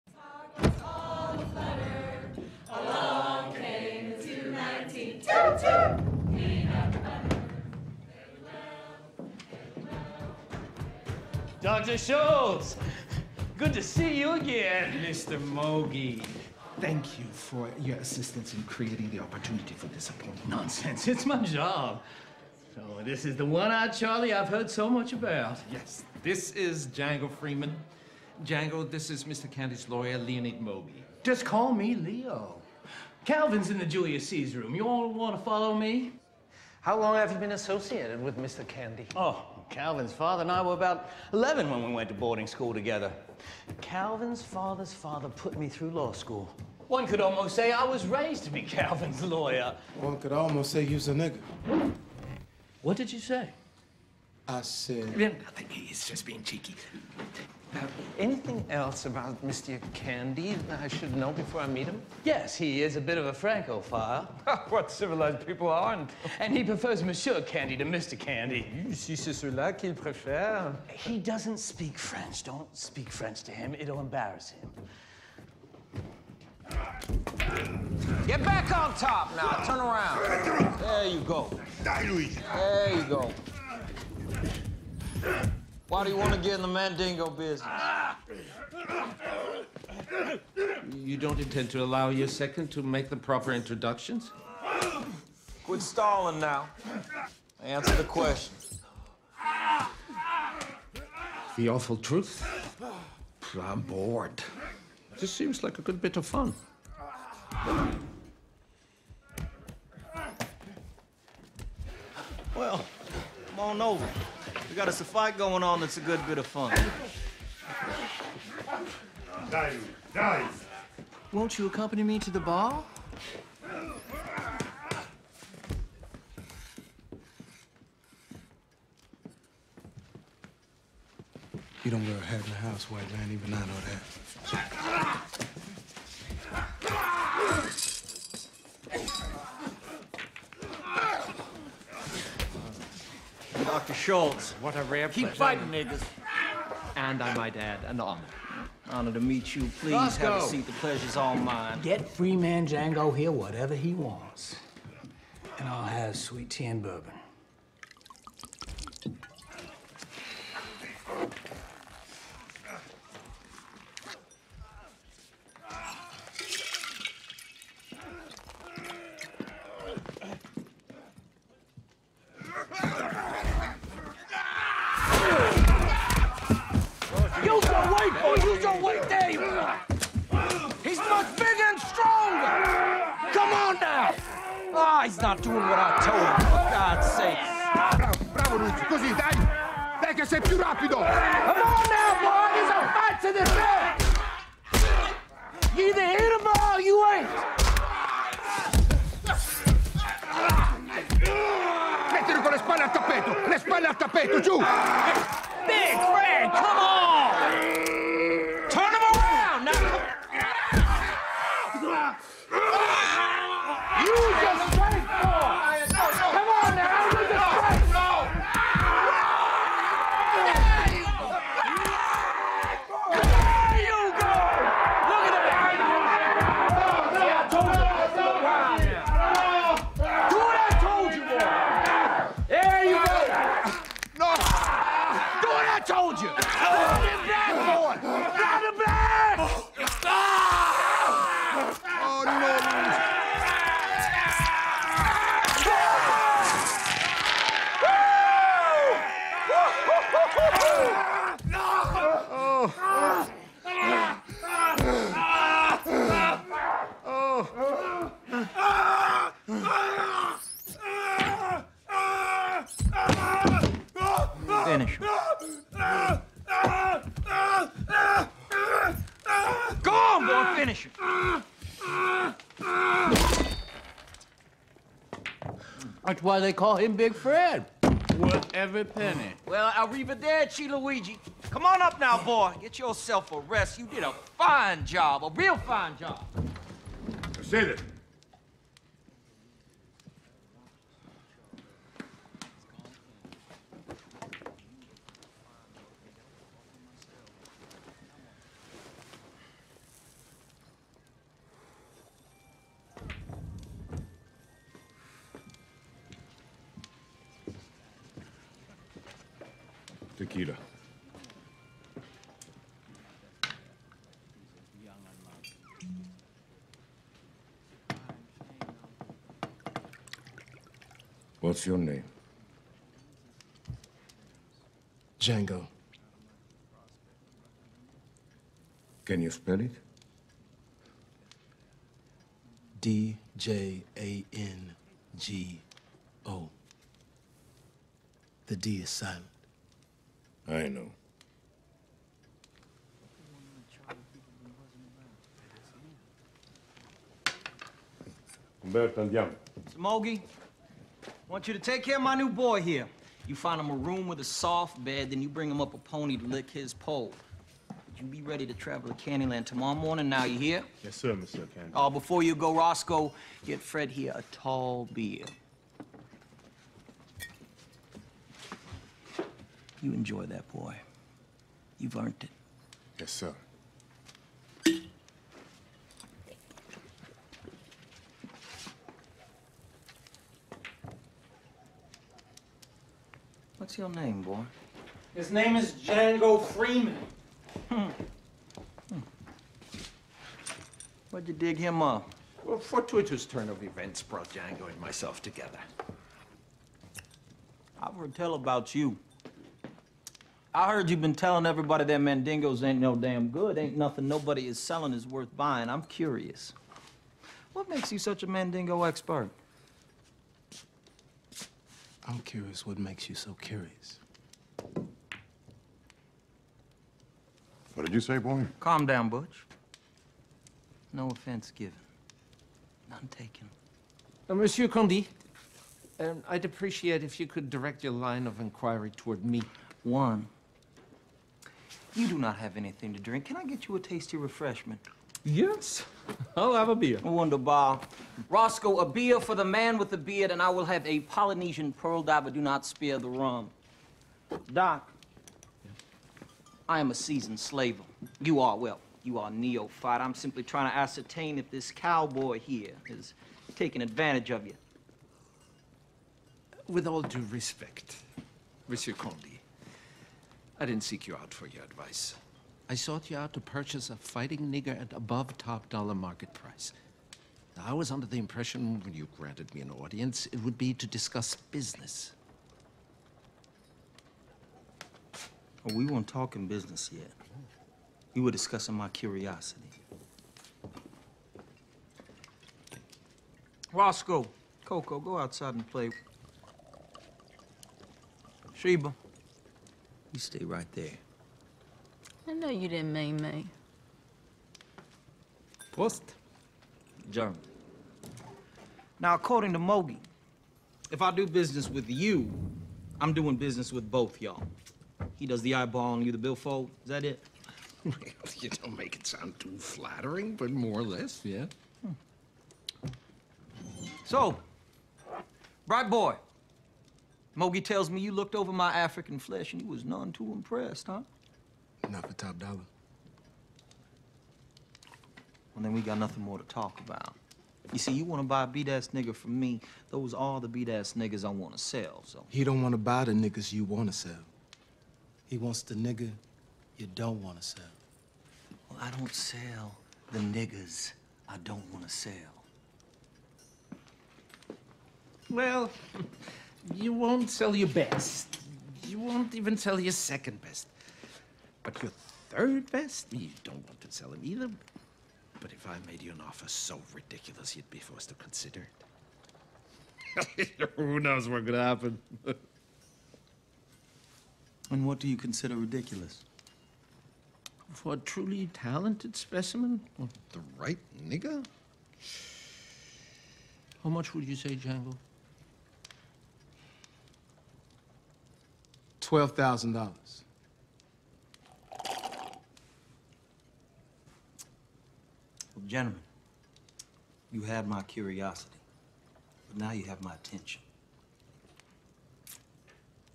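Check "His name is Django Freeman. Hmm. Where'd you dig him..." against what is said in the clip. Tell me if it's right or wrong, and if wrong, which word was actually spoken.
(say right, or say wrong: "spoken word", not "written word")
right.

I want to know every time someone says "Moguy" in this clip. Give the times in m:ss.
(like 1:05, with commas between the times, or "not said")
0:15, 0:30, 8:19, 8:37.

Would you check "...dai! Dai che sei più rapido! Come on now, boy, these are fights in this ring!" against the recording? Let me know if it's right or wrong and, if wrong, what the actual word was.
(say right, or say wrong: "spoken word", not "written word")
right.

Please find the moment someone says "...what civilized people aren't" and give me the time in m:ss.
1:04.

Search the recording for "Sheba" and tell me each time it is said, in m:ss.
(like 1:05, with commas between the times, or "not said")
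8:08.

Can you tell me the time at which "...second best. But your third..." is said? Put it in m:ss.
9:09.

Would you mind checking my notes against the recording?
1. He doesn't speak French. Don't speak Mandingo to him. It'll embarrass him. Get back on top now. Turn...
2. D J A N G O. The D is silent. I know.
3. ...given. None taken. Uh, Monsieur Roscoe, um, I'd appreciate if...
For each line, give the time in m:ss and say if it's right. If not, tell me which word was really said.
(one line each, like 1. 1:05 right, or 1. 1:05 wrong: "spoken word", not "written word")
1. 1:10 wrong: "French", not "Mandingo"
2. 5:32 right
3. 7:01 wrong: "Candie", not "Roscoe".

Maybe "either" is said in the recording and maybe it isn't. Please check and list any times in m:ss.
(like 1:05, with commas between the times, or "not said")
3:15, 9:14.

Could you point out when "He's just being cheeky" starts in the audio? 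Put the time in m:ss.
0:55.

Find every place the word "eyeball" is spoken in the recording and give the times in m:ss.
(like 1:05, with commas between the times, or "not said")
8:25.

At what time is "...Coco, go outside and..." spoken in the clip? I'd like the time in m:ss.
8:04.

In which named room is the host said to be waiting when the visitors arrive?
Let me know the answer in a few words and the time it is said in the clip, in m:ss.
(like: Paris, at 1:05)
Julius Caesar room, at 0:33.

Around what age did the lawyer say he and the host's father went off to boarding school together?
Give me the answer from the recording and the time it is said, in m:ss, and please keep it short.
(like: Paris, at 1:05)
11, at 0:41.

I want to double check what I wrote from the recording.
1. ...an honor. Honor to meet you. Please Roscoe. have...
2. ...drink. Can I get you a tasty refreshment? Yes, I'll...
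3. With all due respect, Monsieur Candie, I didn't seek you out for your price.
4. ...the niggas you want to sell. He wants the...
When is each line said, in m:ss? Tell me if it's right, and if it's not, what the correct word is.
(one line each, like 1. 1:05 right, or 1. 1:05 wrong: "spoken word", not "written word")
1. 2:27 right
2. 7:12 right
3. 7:36 wrong: "advice", not "price"
4. 8:53 right.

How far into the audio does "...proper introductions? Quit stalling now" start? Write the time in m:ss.
1:33.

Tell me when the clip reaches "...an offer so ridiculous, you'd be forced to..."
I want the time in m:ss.
9:16.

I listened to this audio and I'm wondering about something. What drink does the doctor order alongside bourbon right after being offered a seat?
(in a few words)
Sweet tea.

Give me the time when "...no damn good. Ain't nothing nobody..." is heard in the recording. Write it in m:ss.
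6:42.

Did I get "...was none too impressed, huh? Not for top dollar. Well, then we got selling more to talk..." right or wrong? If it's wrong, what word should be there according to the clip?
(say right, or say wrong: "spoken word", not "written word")
wrong: "nothing", not "selling".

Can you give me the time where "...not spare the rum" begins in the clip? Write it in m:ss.
7:22.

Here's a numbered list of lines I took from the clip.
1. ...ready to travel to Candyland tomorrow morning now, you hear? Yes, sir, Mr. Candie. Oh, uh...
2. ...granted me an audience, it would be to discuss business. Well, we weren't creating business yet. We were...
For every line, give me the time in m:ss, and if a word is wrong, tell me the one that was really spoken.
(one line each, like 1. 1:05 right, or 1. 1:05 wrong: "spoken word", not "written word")
1. 5:58 right
2. 7:49 wrong: "talking", not "creating".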